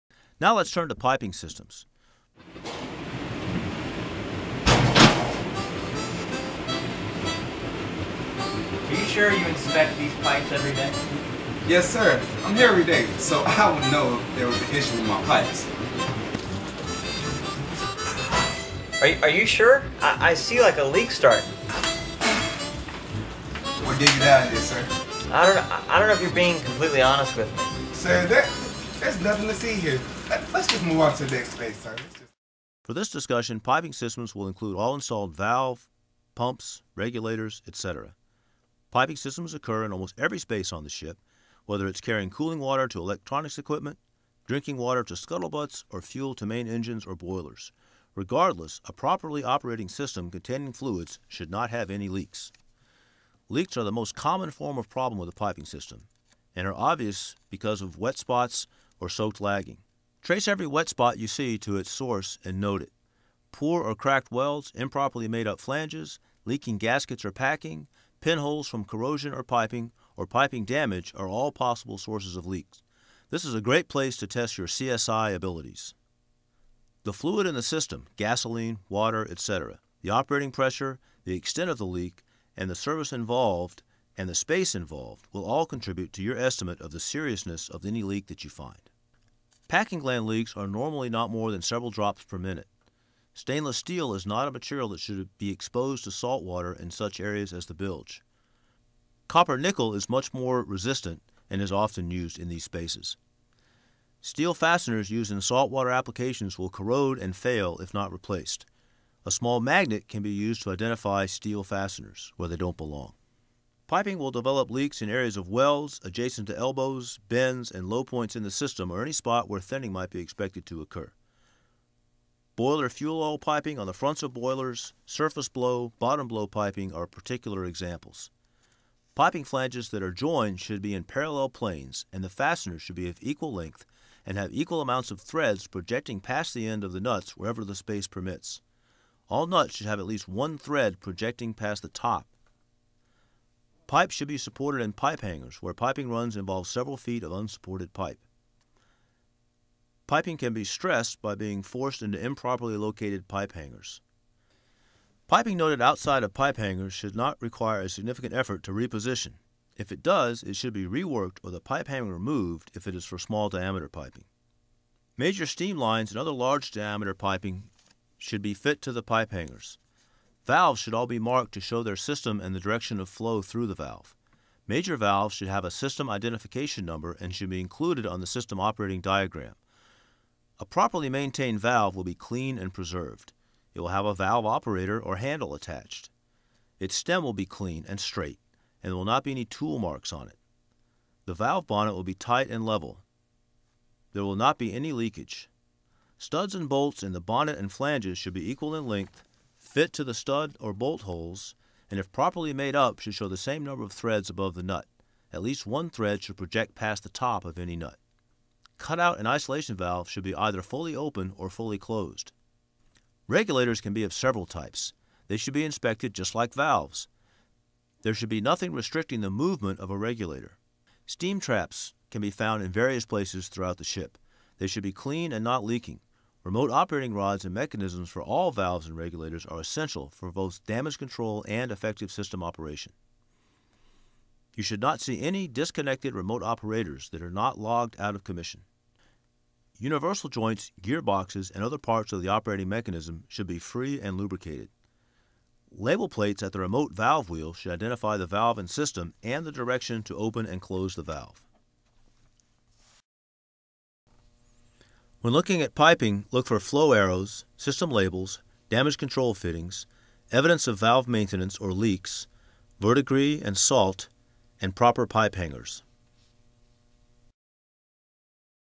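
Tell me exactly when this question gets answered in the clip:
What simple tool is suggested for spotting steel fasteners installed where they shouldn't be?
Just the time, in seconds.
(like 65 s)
109 s.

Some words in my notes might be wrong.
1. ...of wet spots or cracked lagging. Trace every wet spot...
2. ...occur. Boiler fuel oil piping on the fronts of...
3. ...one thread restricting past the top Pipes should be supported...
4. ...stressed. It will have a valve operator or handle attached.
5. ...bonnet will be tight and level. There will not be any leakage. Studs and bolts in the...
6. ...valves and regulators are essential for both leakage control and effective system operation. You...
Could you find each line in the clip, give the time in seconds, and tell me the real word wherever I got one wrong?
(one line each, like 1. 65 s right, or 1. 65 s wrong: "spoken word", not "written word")
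1. 57 s wrong: "soaked", not "cracked"
2. 120 s right
3. 140 s wrong: "projecting", not "restricting"
4. 182 s wrong: "preserved", not "stressed"
5. 191 s right
6. 228 s wrong: "damage", not "leakage".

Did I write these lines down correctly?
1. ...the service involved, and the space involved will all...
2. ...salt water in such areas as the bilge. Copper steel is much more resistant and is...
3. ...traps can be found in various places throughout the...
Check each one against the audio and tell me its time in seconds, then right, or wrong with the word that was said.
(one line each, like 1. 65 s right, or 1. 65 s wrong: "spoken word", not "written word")
1. 82 s right
2. 96 s wrong: "nickel", not "steel"
3. 221 s right.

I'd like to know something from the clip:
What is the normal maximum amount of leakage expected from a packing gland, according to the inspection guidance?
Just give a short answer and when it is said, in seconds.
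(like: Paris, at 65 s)
several drops per minute, at 91 s.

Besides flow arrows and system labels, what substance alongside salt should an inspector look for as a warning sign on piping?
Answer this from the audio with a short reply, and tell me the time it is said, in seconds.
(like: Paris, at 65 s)
Verdigris, at 262 s.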